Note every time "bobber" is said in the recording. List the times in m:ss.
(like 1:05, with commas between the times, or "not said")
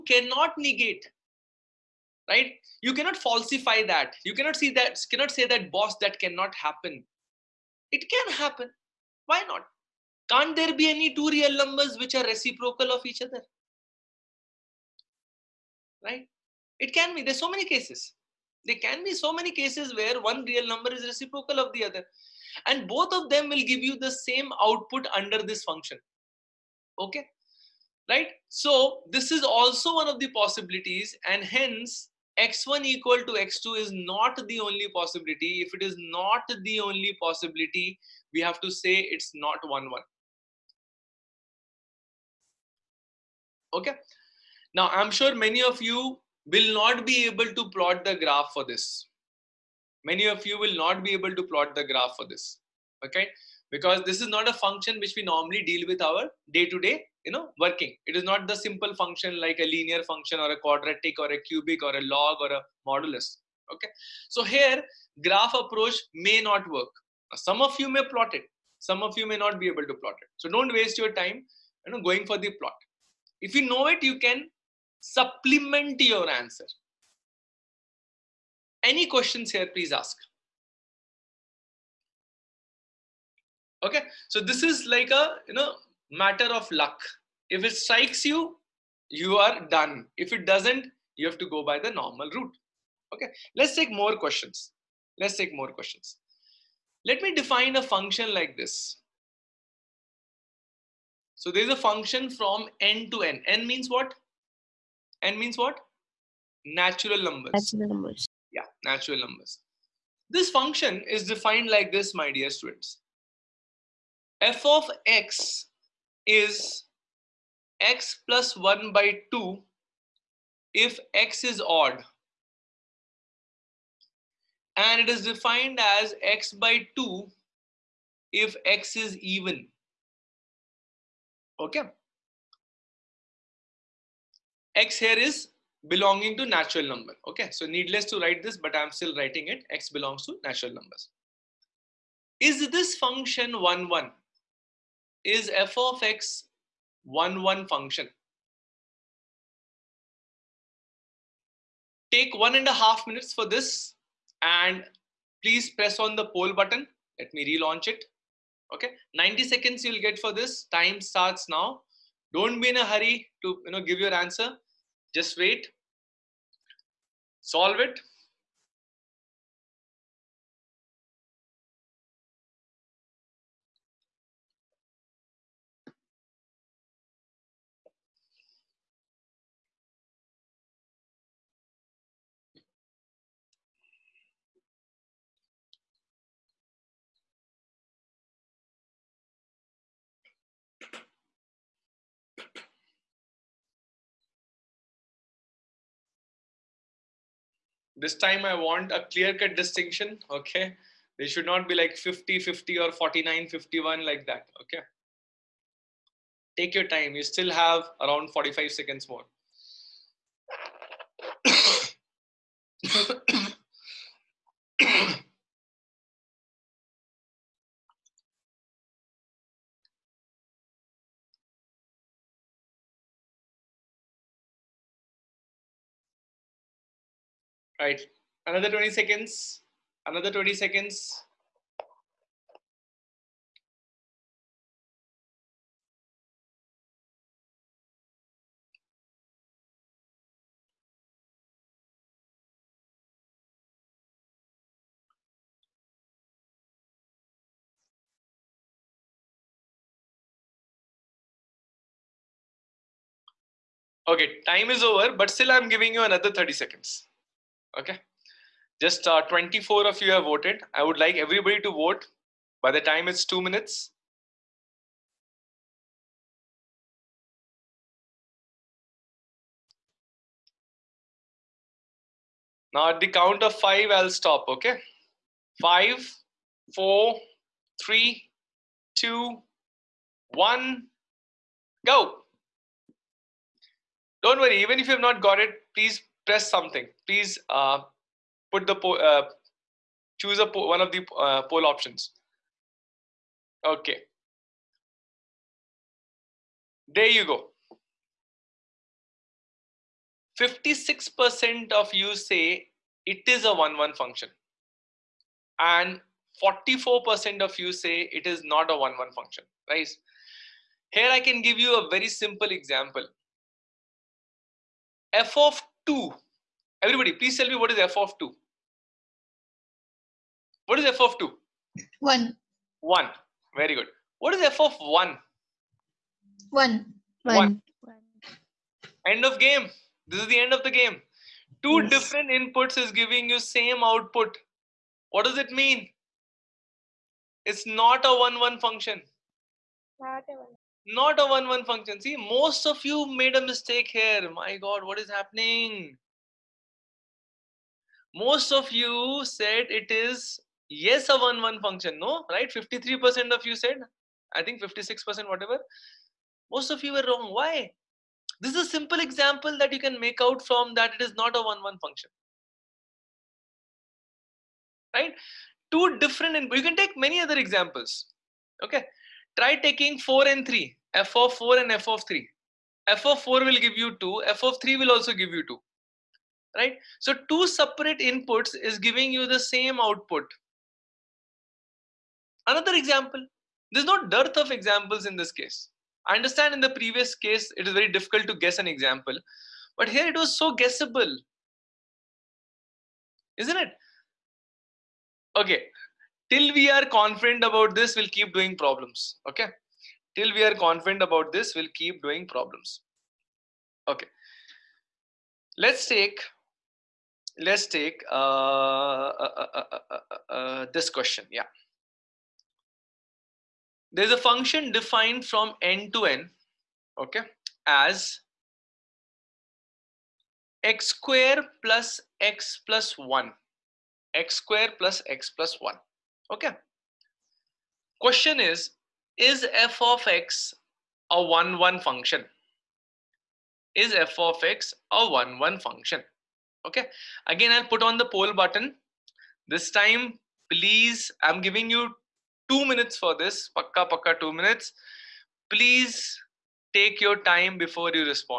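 not said.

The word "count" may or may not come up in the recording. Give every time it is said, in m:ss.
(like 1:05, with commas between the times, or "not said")
4:33.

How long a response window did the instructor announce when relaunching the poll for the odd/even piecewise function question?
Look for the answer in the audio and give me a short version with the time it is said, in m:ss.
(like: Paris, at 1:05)
90 seconds, at 2:39.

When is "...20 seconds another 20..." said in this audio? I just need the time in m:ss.
3:48.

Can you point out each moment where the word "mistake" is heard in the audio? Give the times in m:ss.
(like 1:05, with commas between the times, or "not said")
5:43.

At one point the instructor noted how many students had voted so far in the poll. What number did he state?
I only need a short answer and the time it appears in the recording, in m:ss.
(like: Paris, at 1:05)
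24, at 4:19.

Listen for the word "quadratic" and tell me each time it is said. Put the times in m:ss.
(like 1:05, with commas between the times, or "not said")
1:00.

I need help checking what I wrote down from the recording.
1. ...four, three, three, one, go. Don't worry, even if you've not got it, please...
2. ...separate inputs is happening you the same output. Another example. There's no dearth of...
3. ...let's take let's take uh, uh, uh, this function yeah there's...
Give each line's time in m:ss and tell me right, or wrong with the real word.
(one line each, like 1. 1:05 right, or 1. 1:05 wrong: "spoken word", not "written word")
1. 4:36 wrong: "two", not "three"
2. 6:17 wrong: "giving", not "happening"
3. 6:45 wrong: "question", not "function".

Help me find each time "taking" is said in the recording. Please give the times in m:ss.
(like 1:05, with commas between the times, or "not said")
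6:09.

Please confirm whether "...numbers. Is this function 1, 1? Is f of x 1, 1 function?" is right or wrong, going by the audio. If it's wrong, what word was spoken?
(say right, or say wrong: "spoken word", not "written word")
right.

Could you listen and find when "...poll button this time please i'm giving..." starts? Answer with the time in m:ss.
7:18.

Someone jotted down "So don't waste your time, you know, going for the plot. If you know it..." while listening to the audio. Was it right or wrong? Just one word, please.
right.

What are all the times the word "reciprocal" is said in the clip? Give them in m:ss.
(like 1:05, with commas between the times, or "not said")
0:12, 0:21.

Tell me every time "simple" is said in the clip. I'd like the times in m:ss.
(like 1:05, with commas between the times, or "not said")
0:58, 5:12, 5:58.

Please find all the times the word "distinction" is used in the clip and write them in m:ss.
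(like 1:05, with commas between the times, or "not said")
3:19.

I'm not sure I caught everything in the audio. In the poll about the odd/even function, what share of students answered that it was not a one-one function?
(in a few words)
44%.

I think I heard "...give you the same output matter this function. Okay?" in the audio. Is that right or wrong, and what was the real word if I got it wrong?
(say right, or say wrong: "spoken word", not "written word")
wrong: "under", not "matter".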